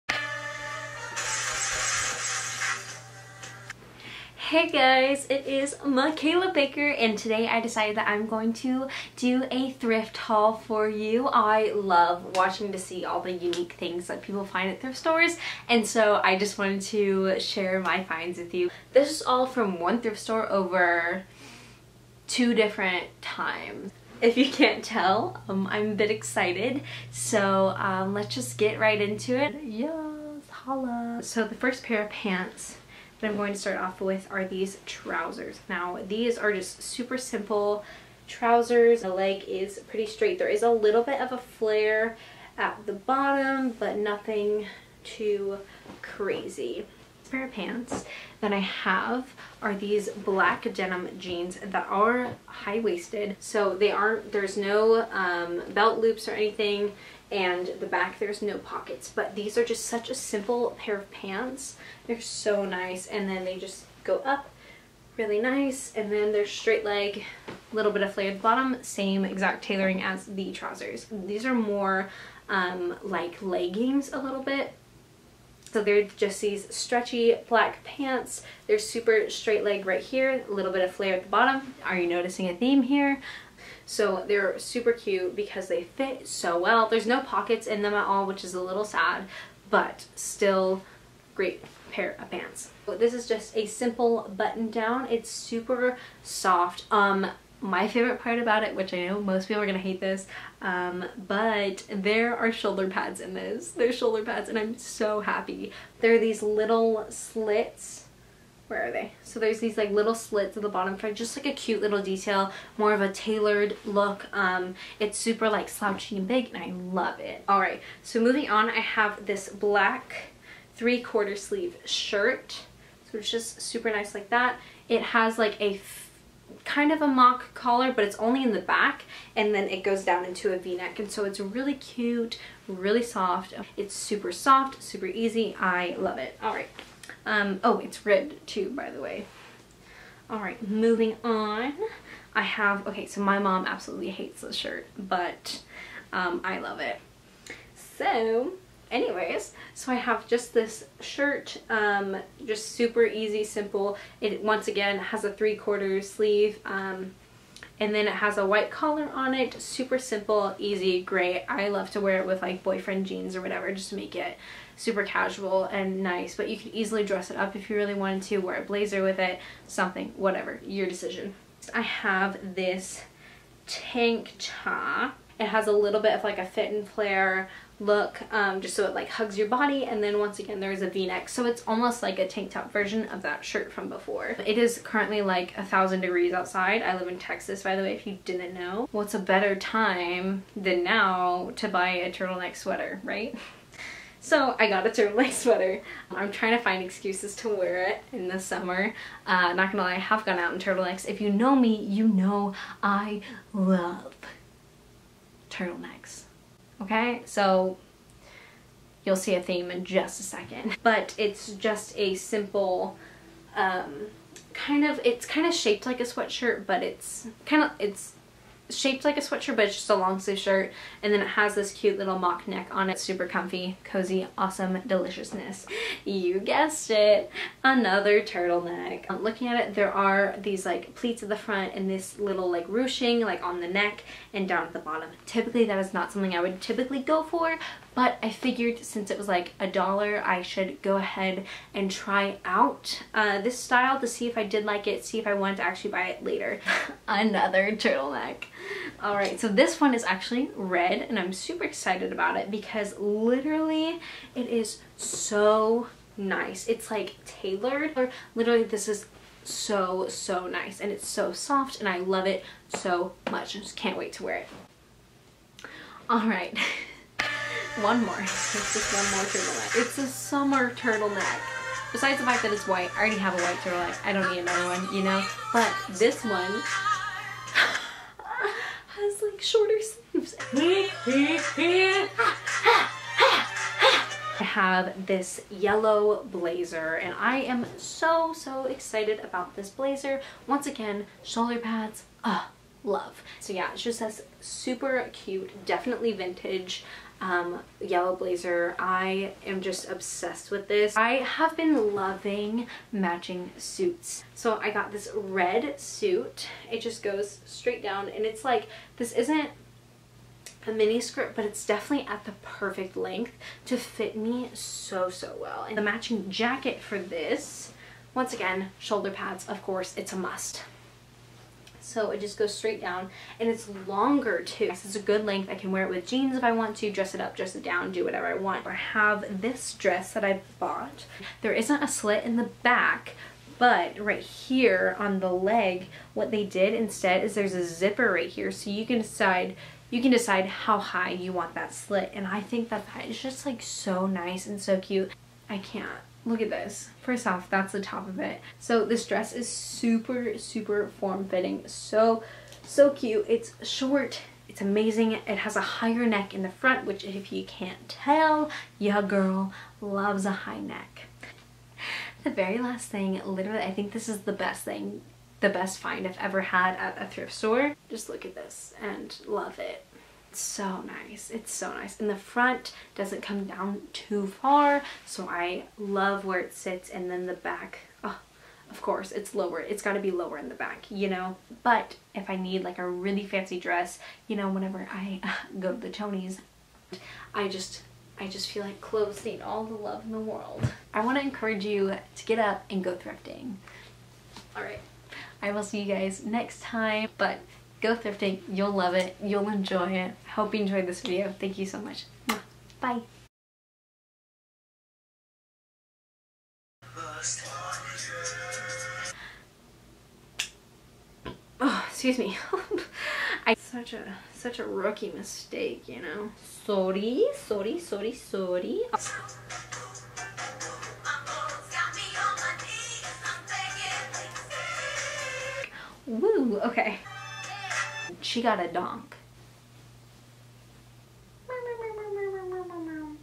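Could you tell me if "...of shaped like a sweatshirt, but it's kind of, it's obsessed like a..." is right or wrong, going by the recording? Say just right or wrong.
wrong.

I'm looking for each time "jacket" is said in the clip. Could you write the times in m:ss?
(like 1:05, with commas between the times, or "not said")
5:16.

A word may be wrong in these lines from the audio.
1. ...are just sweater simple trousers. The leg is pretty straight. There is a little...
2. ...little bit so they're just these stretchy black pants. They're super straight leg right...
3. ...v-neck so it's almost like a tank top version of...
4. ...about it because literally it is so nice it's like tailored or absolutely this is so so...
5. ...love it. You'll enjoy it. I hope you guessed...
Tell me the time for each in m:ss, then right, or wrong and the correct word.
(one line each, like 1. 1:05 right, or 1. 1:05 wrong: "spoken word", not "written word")
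1. 0:36 wrong: "super", not "sweater"
2. 1:14 right
3. 3:00 right
4. 4:12 wrong: "literally", not "absolutely"
5. 6:38 wrong: "enjoyed", not "guessed".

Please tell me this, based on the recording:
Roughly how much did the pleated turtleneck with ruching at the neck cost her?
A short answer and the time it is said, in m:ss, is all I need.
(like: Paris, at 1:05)
a dollar, at 3:59.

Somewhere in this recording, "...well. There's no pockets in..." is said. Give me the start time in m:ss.
1:26.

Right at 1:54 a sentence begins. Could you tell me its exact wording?
Um, it's super like slouchy and big and I love it.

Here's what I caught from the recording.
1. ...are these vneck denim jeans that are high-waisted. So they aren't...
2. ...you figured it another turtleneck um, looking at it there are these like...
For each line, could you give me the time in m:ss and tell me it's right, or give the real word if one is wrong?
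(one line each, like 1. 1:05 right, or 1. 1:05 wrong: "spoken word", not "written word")
1. 0:49 wrong: "black", not "vneck"
2. 3:46 wrong: "guessed", not "figured".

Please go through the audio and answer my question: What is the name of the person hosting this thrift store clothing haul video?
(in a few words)
Mikaela Baker.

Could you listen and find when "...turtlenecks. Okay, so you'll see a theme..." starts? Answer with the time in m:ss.
3:25.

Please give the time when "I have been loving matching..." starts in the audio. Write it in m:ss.
5:00.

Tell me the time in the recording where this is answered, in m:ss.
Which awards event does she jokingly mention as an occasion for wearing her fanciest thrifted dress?
6:25.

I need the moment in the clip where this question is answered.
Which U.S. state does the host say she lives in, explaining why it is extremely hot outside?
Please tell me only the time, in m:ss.
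3:07.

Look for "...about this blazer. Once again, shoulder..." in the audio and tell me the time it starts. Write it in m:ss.
4:49.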